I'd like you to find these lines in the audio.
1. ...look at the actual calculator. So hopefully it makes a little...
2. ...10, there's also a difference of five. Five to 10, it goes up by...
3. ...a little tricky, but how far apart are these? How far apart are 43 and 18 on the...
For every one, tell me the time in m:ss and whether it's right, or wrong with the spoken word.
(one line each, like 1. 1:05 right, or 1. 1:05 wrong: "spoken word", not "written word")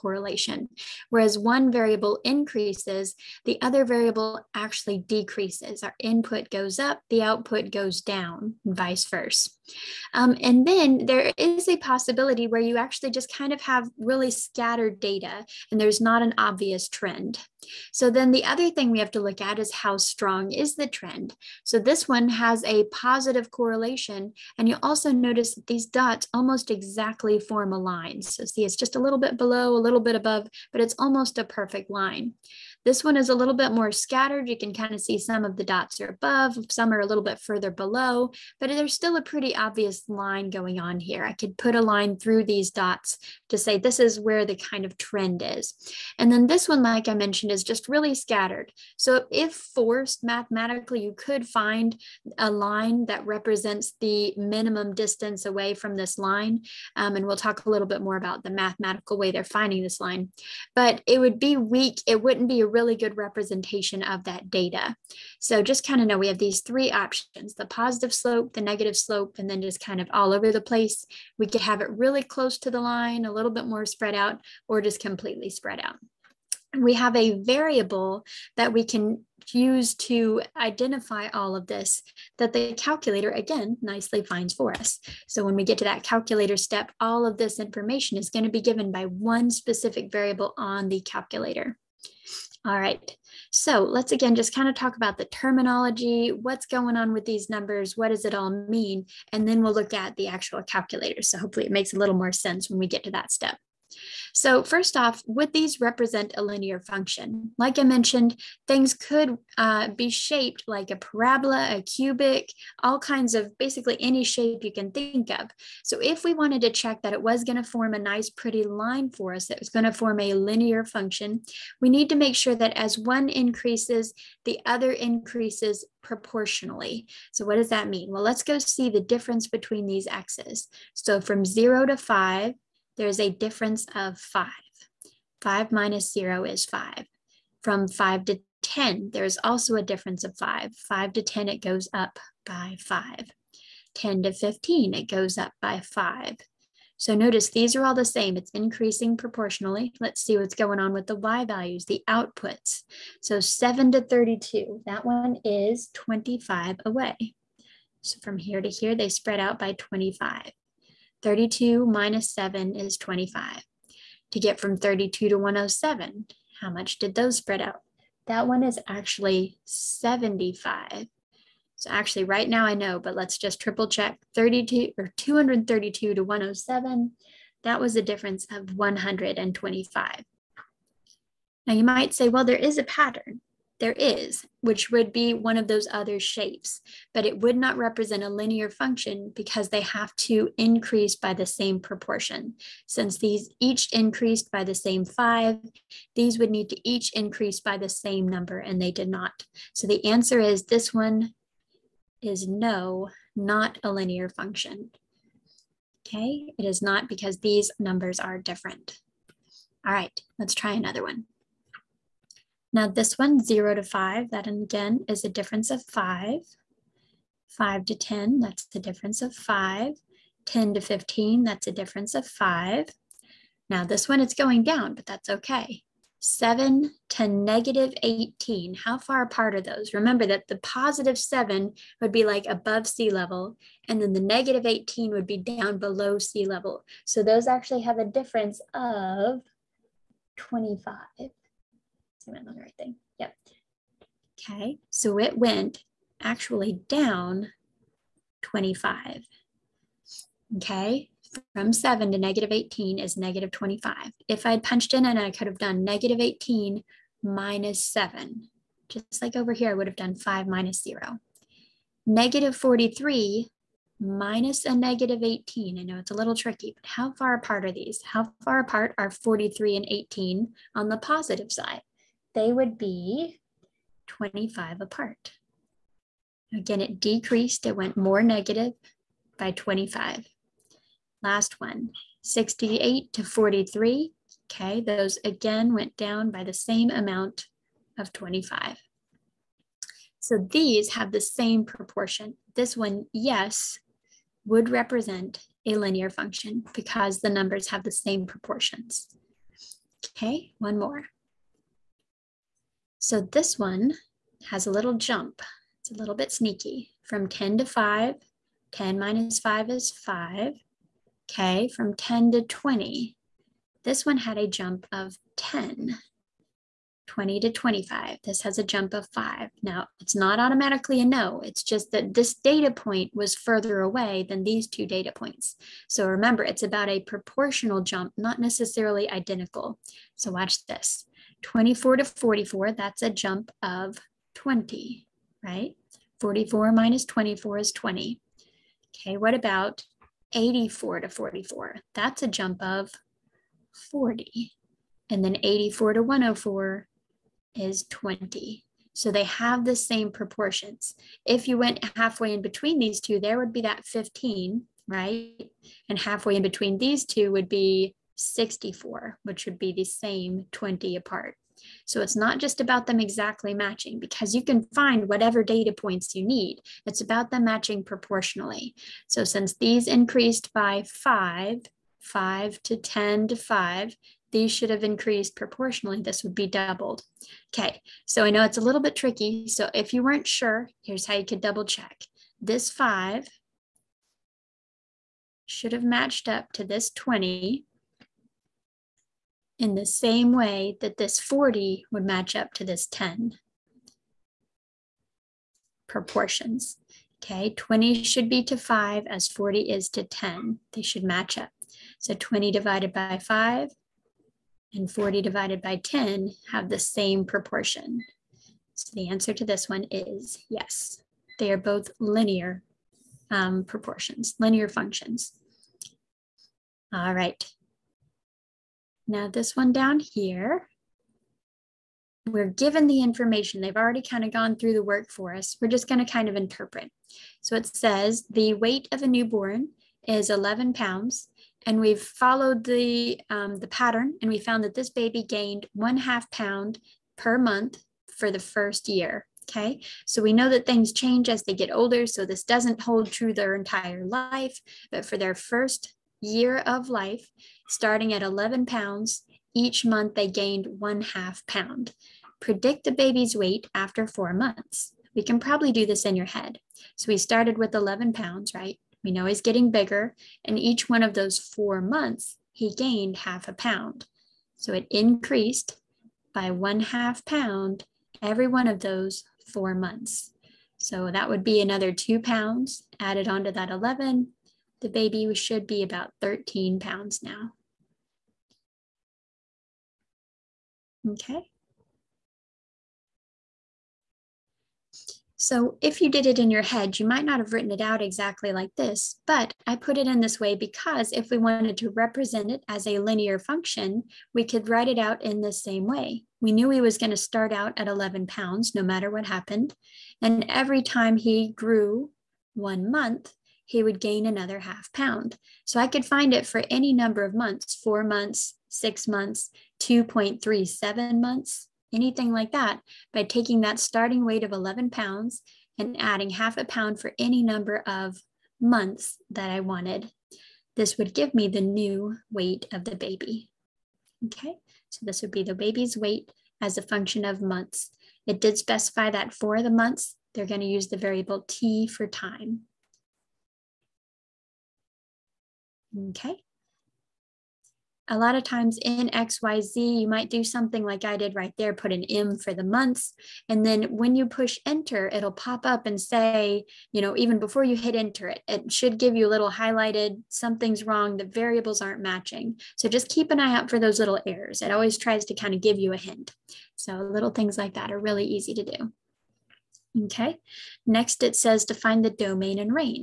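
1. 1:39 right
2. 2:18 right
3. 4:26 right.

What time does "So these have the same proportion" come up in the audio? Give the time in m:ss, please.
4:50.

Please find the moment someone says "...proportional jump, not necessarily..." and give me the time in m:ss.
5:26.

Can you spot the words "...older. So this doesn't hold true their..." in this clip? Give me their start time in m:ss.
7:21.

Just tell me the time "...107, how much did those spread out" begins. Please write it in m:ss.
2:45.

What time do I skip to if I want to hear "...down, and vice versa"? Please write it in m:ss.
0:07.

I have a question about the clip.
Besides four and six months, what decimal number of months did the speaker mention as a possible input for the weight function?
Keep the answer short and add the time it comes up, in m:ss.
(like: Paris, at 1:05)
2.37 months, at 8:29.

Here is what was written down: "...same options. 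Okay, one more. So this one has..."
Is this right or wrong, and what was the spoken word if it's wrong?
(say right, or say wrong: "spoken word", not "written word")
wrong: "proportions", not "options".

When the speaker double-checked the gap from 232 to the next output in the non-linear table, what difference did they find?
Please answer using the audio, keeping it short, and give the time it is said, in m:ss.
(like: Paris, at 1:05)
125, at 2:57.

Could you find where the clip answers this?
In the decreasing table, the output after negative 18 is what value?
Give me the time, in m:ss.
4:22.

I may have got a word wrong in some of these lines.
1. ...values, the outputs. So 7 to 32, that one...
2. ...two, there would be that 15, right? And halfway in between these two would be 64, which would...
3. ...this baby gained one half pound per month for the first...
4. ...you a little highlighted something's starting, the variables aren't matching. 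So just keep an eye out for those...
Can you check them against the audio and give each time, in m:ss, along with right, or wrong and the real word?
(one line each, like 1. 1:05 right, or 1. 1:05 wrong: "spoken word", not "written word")
1. 2:31 right
2. 5:52 right
3. 7:14 right
4. 9:09 wrong: "wrong", not "starting".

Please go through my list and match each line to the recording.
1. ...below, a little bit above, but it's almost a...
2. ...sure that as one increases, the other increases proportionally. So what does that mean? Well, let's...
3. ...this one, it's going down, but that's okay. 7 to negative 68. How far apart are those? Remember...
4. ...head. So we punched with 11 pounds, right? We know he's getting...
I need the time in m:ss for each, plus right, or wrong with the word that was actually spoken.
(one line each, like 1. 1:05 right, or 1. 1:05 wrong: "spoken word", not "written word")
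1. 0:29 right
2. 2:02 right
3. 3:43 wrong: "18", not "68"
4. 7:36 wrong: "started", not "punched".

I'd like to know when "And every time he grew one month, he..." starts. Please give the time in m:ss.
8:20.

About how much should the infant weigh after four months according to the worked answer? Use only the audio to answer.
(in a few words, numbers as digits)
13 pounds.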